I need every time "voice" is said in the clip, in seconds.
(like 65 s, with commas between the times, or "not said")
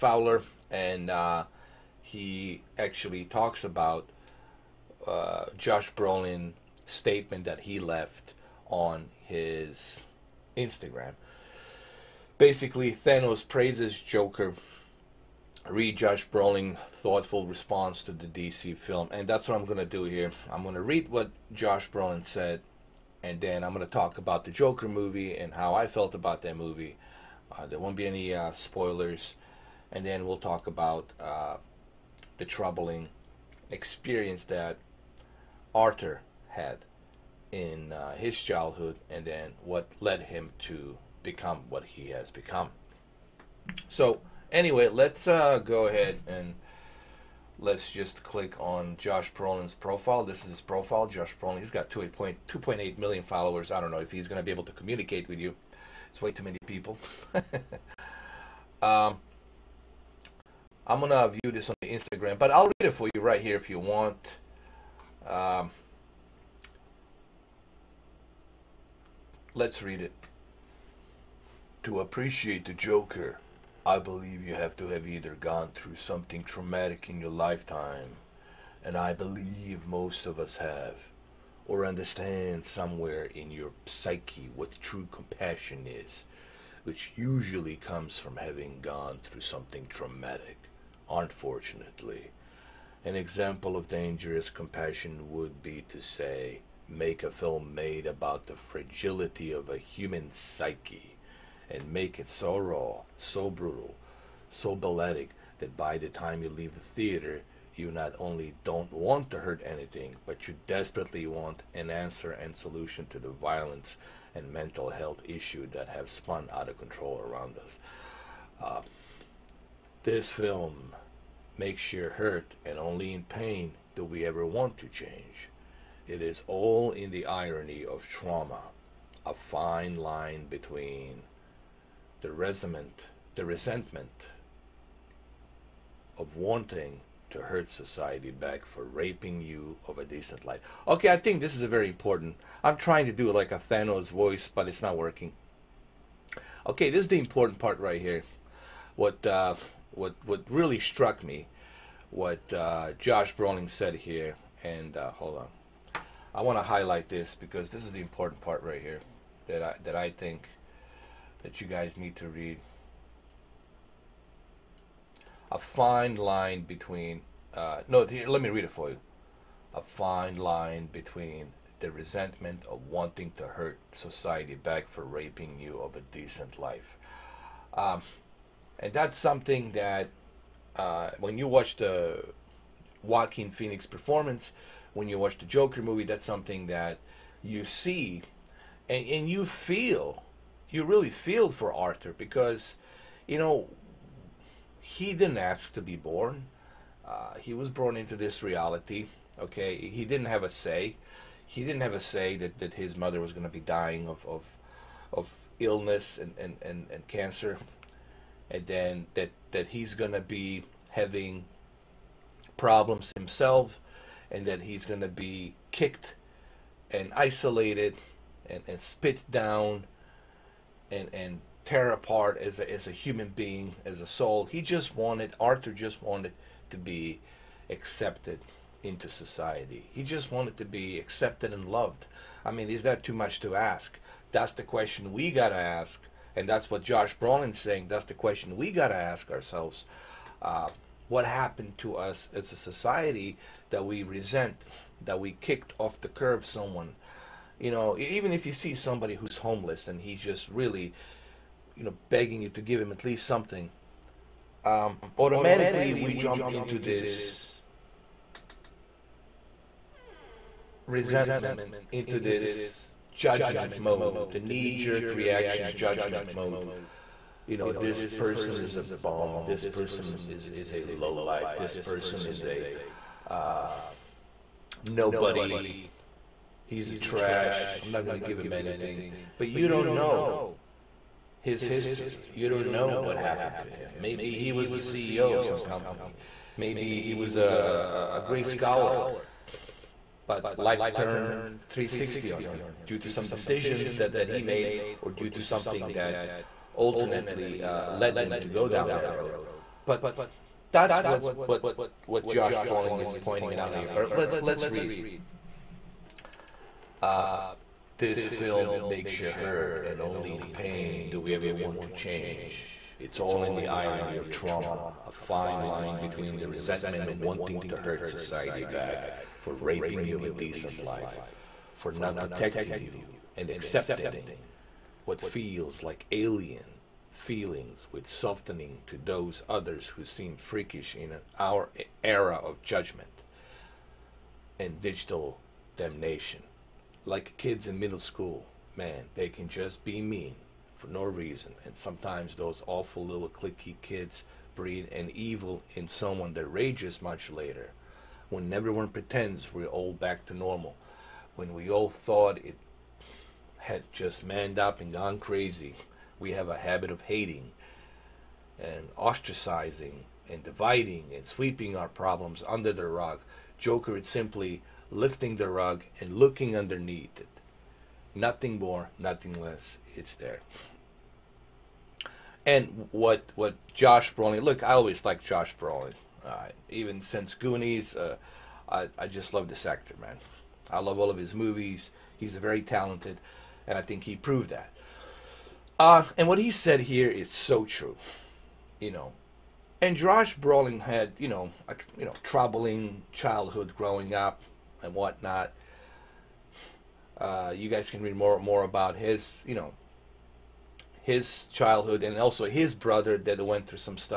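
144 s.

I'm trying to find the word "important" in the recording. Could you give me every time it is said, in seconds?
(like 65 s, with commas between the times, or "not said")
141 s, 147 s, 158 s.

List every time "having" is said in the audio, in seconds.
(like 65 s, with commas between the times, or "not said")
88 s, 210 s.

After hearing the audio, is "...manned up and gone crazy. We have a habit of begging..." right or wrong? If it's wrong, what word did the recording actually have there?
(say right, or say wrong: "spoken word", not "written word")
wrong: "hating", not "begging".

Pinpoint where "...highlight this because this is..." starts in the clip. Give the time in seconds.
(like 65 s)
156 s.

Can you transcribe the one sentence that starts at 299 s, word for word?
But that's what, what, what Josh Brolin is pointing out here.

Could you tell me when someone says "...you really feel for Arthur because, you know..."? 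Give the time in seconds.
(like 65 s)
190 s.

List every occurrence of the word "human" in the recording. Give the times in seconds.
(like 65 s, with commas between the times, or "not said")
99 s, 222 s.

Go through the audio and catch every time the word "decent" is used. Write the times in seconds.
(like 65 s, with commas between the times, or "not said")
140 s, 176 s, 320 s.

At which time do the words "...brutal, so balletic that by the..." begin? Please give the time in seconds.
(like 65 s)
103 s.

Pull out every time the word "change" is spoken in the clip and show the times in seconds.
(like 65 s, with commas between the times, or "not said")
124 s, 311 s.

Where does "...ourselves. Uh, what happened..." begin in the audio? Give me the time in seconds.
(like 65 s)
239 s.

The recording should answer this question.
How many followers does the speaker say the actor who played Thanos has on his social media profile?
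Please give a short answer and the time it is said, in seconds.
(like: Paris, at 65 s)
2.8 million, at 51 s.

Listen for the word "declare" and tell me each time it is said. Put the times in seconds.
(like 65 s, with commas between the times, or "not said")
not said.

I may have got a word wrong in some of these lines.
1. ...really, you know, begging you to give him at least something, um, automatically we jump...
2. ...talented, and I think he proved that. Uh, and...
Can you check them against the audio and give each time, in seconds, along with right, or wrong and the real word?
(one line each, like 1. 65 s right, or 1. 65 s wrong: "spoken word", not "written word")
1. 250 s right
2. 382 s right.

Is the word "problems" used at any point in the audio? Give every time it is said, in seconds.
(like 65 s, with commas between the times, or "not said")
212 s, 361 s.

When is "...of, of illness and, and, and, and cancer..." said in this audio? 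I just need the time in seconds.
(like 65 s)
204 s.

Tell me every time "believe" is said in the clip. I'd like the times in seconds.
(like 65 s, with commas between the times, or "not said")
73 s, 79 s.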